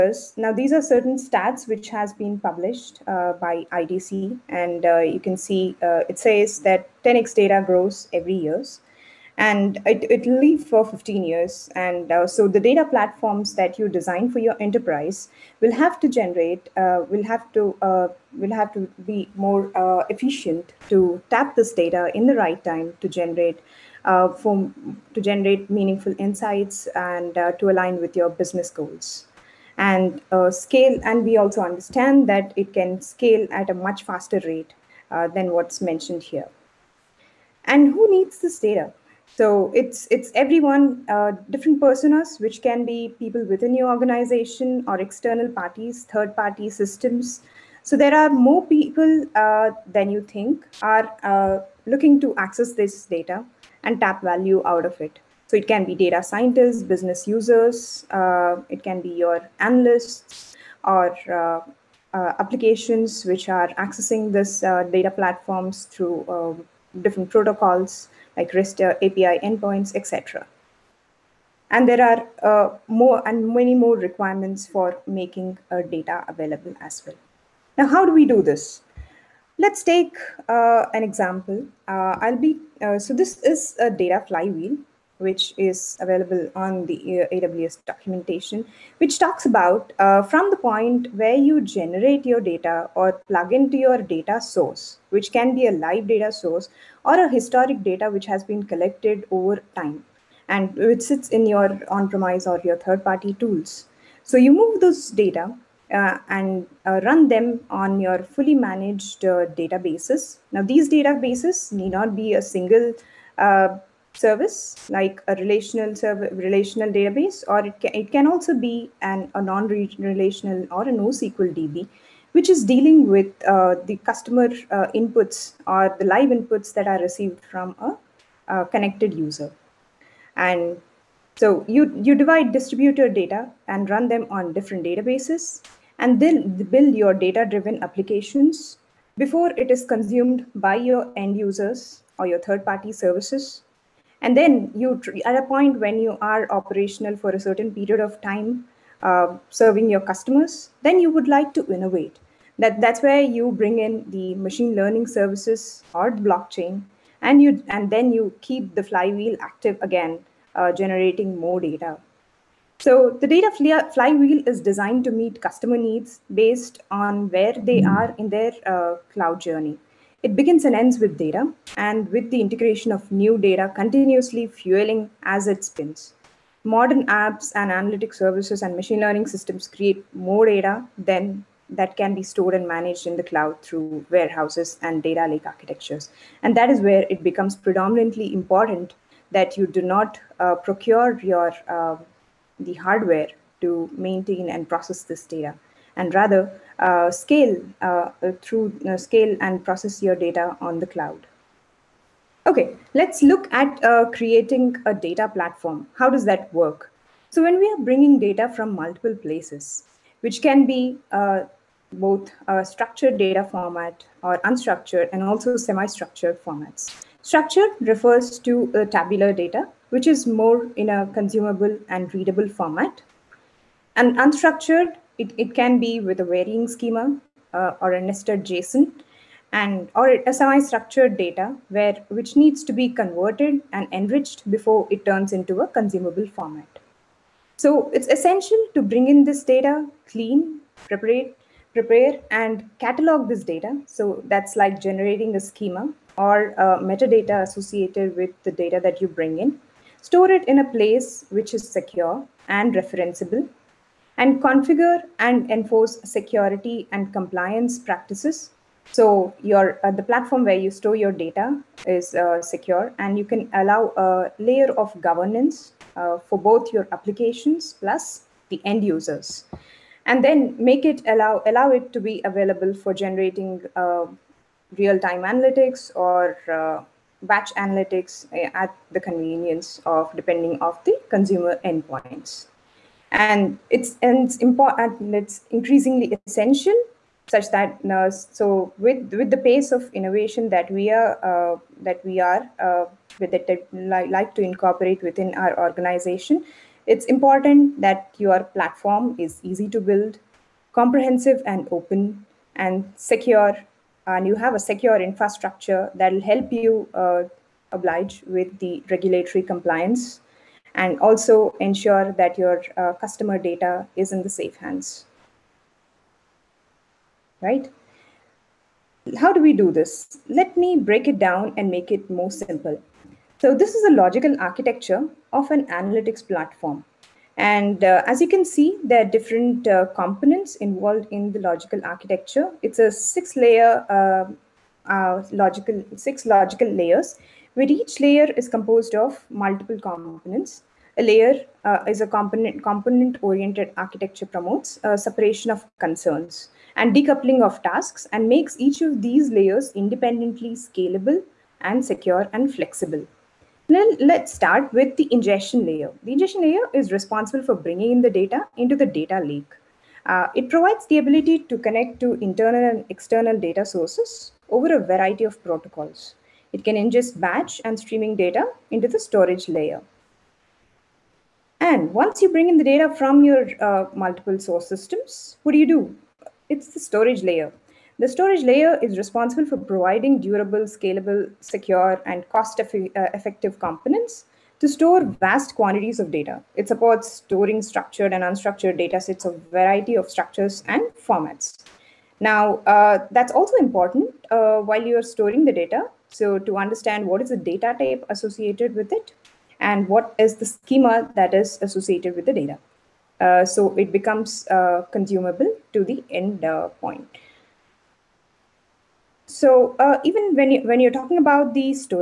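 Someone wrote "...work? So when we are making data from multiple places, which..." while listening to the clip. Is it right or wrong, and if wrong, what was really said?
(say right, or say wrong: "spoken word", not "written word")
wrong: "bringing", not "making".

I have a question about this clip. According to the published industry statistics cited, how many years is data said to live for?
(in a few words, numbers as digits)
15 years.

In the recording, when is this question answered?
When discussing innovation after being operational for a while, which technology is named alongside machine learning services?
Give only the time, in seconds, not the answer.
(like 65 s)
156 s.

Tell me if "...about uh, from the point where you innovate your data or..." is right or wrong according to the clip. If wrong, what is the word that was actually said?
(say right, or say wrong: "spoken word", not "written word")
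wrong: "generate", not "innovate".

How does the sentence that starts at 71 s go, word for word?
And there are uh, more and many more requirements for making uh, data available as well.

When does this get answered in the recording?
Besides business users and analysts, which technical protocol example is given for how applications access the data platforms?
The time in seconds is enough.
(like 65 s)
68 s.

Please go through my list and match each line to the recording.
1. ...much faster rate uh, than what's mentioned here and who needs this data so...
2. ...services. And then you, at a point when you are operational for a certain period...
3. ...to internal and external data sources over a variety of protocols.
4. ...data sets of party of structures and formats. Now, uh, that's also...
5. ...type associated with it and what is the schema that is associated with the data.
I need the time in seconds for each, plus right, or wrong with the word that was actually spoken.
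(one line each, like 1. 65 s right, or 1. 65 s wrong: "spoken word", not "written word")
1. 33 s right
2. 142 s right
3. 361 s right
4. 388 s wrong: "variety", not "party"
5. 397 s right.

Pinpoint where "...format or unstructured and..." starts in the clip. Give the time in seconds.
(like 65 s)
213 s.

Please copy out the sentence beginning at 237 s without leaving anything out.
So it's essential to bring in this data, clean, prepare, prepare and catalog this data.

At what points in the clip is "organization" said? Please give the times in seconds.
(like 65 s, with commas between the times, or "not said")
43 s, 295 s.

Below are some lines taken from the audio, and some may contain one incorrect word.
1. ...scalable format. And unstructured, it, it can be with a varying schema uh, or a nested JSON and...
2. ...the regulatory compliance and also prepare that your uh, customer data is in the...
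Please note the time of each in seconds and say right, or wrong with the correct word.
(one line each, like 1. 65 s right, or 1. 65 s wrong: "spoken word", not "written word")
1. 222 s wrong: "readable", not "scalable"
2. 308 s wrong: "ensure", not "prepare".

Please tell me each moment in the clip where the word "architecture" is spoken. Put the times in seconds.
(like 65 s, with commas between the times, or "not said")
185 s, 324 s, 331 s, 343 s.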